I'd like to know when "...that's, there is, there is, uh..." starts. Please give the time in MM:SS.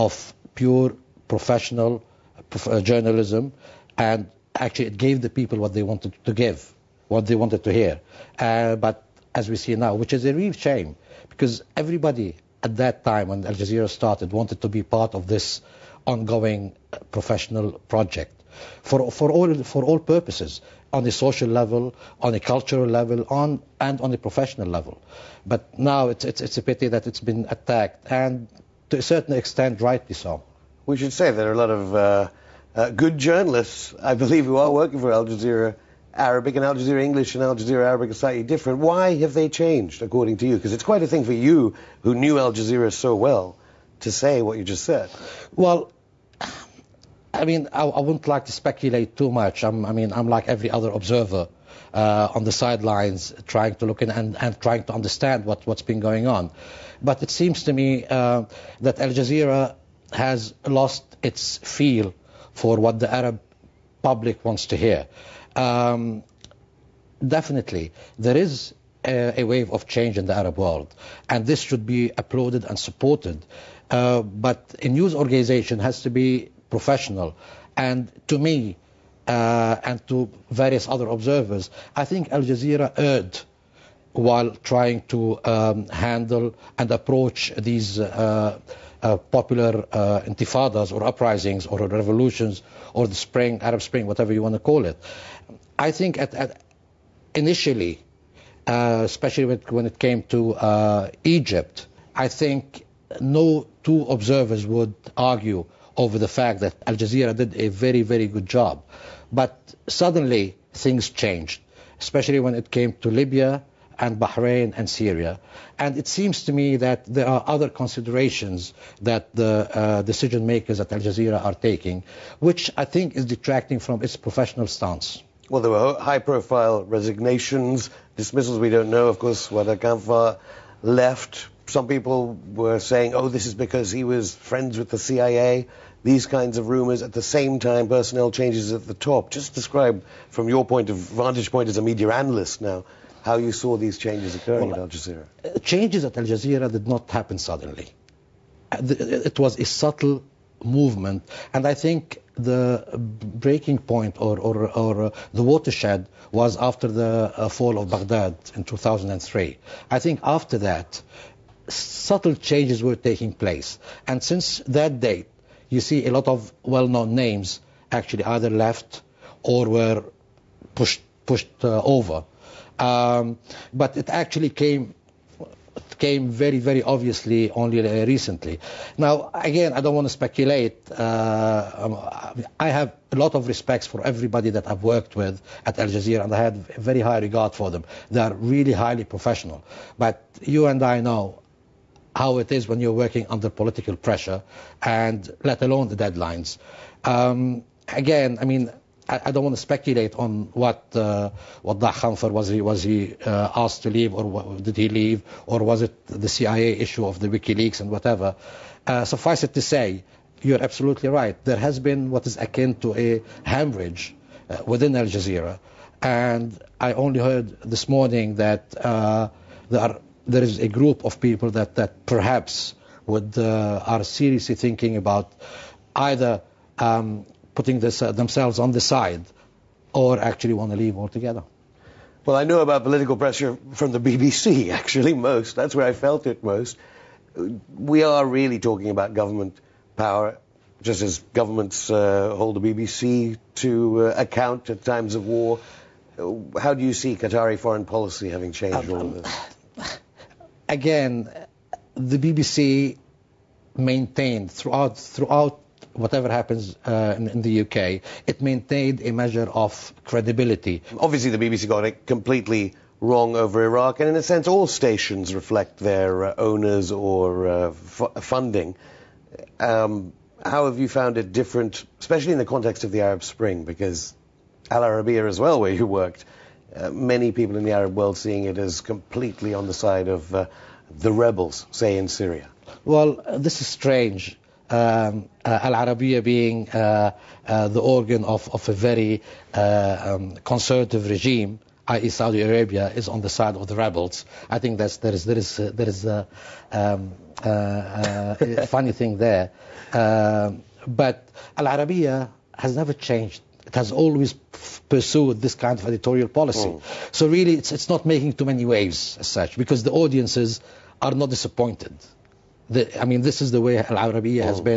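04:54.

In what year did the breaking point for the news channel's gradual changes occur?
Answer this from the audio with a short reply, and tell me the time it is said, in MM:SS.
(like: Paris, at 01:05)
2003, at 02:38.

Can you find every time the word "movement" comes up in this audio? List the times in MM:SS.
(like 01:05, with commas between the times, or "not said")
02:30.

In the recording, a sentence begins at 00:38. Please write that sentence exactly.
Why have they changed, according to you?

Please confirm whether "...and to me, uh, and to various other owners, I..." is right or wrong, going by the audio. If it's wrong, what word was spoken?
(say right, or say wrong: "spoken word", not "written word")
wrong: "observers", not "owners".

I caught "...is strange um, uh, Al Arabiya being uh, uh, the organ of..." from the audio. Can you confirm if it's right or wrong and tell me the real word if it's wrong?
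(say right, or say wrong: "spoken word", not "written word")
right.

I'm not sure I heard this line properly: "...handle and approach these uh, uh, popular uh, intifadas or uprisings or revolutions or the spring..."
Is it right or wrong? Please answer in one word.
right.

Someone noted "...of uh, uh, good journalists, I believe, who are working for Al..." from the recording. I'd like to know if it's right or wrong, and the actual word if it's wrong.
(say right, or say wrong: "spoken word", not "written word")
right.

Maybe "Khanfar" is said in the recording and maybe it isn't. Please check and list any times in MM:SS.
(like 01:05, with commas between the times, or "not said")
02:09, 03:21.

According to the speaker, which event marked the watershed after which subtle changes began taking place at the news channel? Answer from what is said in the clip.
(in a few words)
Fall of Baghdad.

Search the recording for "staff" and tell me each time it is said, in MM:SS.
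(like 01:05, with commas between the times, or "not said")
not said.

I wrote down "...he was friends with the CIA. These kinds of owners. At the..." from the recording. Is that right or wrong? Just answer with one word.
wrong.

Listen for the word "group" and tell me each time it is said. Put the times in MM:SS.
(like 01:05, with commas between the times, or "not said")
03:40.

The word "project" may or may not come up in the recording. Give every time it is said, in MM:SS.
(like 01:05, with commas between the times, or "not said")
00:17.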